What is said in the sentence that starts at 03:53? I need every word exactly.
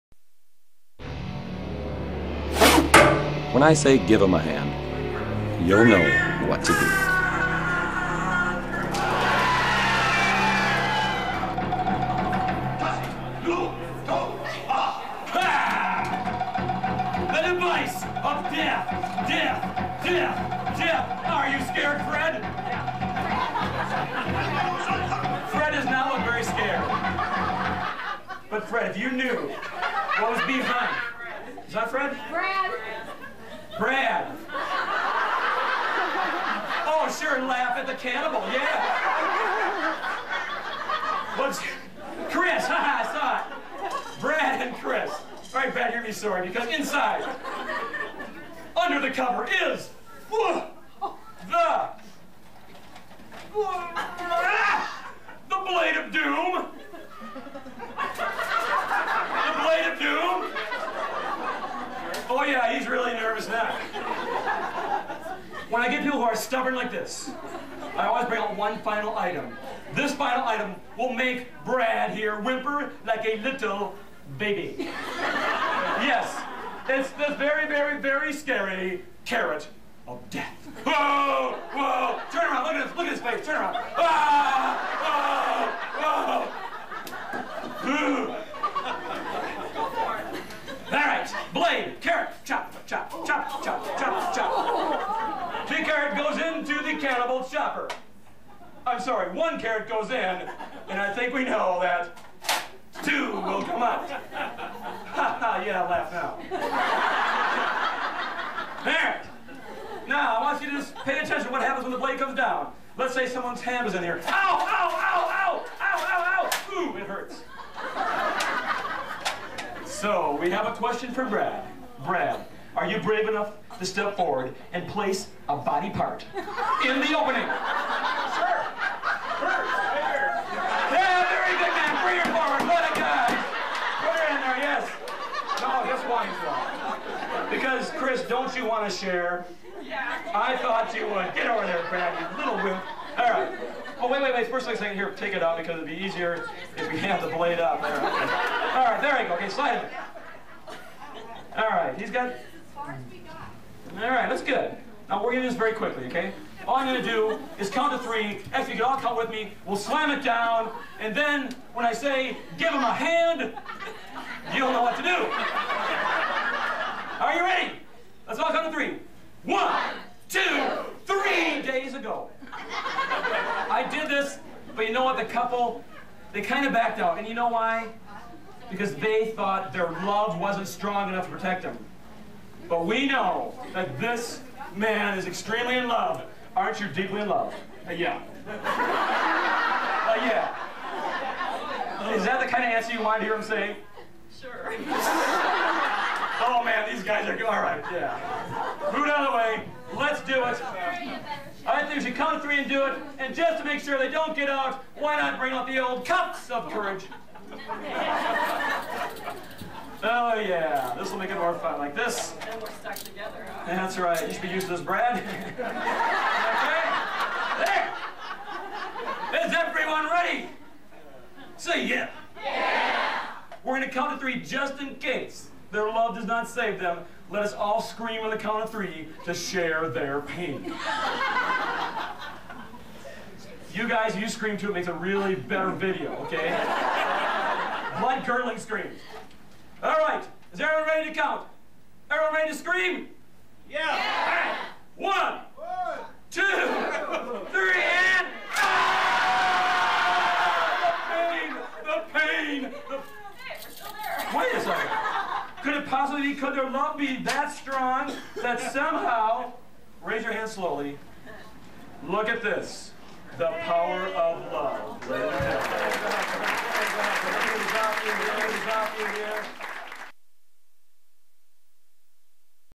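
you guys, you scream too, it makes a really better video, okay?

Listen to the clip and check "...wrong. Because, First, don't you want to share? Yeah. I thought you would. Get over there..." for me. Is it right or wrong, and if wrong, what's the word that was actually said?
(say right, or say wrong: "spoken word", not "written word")
wrong: "Chris", not "First".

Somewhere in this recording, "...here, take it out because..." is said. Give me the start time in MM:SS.
02:24.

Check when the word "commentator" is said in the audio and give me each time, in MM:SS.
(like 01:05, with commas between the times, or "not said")
not said.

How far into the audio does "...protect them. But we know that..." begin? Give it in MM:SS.
03:01.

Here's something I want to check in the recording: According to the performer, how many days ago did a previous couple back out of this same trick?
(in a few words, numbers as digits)
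3.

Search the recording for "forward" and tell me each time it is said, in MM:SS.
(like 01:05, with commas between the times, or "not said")
02:04, 02:12.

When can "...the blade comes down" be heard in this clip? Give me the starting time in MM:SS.
01:51.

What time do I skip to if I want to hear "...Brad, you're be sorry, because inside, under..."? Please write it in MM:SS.
00:45.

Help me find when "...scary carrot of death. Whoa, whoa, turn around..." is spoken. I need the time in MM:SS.
01:18.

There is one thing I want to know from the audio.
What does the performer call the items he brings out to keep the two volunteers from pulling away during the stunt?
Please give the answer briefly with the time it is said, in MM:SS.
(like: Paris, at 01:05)
cups of courage, at 03:26.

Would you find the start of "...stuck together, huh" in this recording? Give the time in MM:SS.
03:32.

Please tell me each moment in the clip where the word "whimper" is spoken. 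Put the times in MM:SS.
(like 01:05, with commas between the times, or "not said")
01:12.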